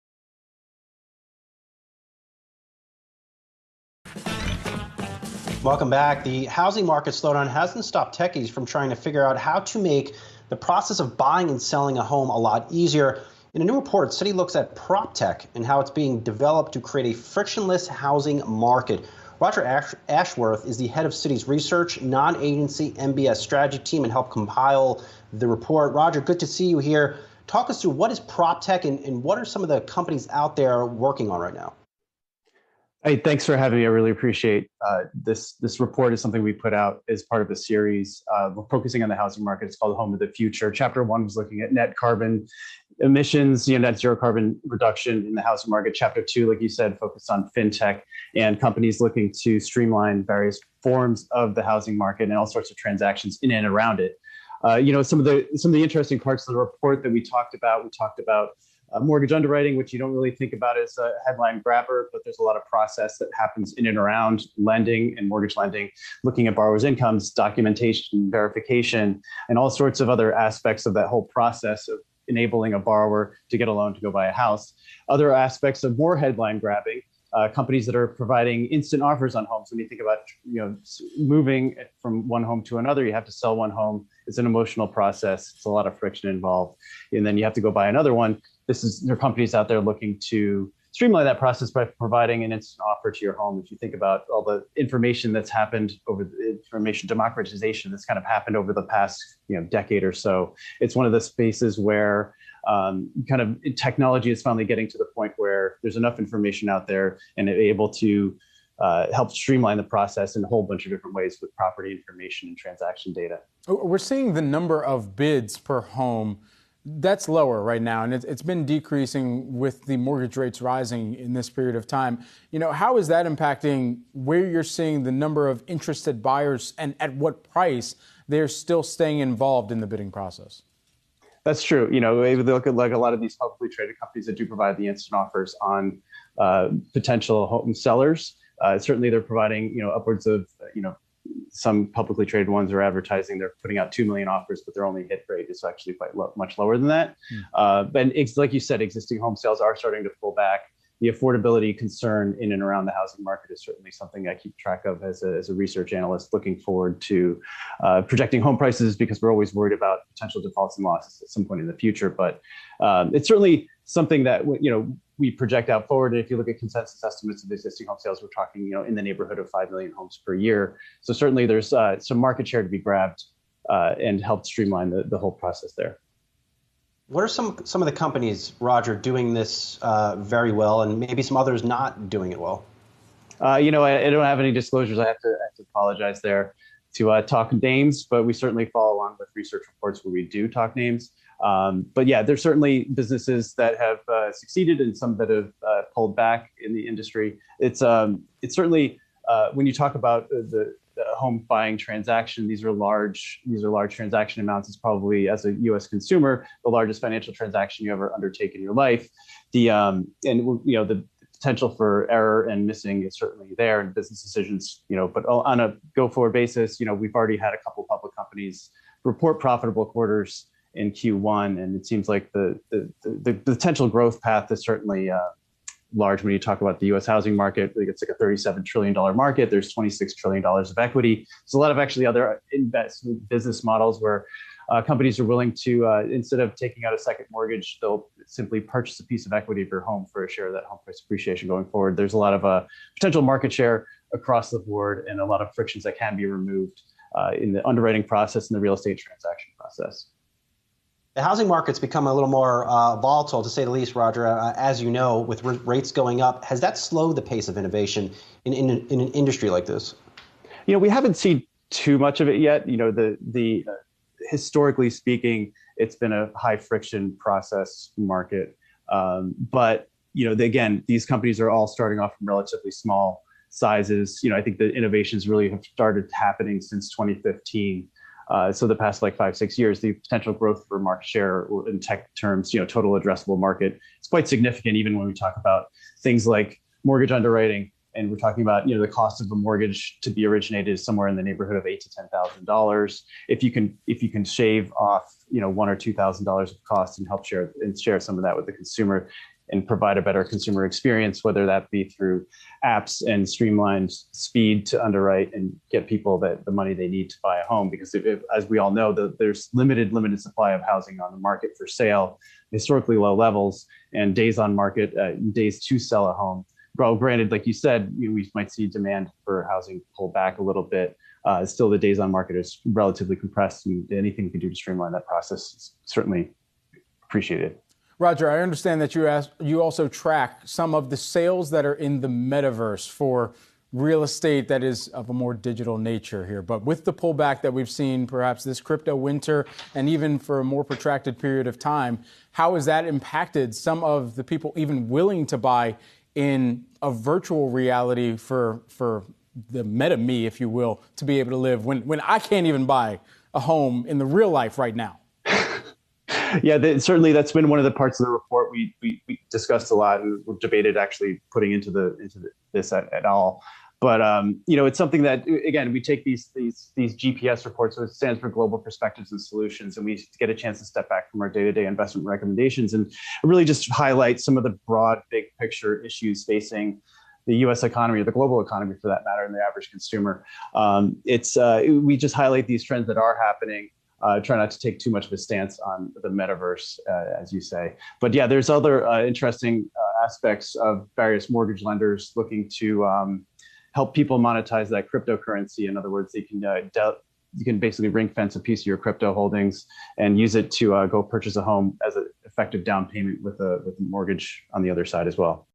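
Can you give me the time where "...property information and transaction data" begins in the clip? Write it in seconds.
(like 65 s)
111 s.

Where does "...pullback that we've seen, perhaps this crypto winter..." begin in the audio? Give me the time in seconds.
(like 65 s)
336 s.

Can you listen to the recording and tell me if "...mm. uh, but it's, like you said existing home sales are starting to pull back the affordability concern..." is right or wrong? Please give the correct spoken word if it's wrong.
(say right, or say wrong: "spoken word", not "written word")
right.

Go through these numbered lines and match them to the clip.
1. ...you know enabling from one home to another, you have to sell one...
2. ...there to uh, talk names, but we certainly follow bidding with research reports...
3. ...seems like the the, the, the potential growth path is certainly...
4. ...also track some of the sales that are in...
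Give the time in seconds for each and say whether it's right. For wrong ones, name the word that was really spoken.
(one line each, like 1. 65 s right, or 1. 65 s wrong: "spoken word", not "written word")
1. 80 s wrong: "moving", not "enabling"
2. 186 s wrong: "along", not "bidding"
3. 221 s right
4. 329 s right.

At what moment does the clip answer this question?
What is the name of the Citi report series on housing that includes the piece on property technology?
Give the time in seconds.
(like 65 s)
39 s.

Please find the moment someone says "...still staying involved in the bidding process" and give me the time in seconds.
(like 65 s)
128 s.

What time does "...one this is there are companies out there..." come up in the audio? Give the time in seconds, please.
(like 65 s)
88 s.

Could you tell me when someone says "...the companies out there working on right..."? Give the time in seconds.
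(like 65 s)
29 s.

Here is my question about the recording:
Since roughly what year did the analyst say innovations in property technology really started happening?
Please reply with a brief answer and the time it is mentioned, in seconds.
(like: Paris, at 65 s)
2015, at 276 s.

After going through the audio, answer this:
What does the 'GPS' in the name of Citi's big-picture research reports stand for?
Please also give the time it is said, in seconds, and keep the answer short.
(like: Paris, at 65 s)
Global Perspectives and Solutions, at 368 s.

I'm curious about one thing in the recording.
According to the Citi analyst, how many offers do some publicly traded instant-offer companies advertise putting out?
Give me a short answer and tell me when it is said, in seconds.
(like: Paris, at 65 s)
2 million, at 143 s.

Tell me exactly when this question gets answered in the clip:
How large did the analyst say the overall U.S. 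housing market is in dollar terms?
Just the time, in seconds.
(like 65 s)
228 s.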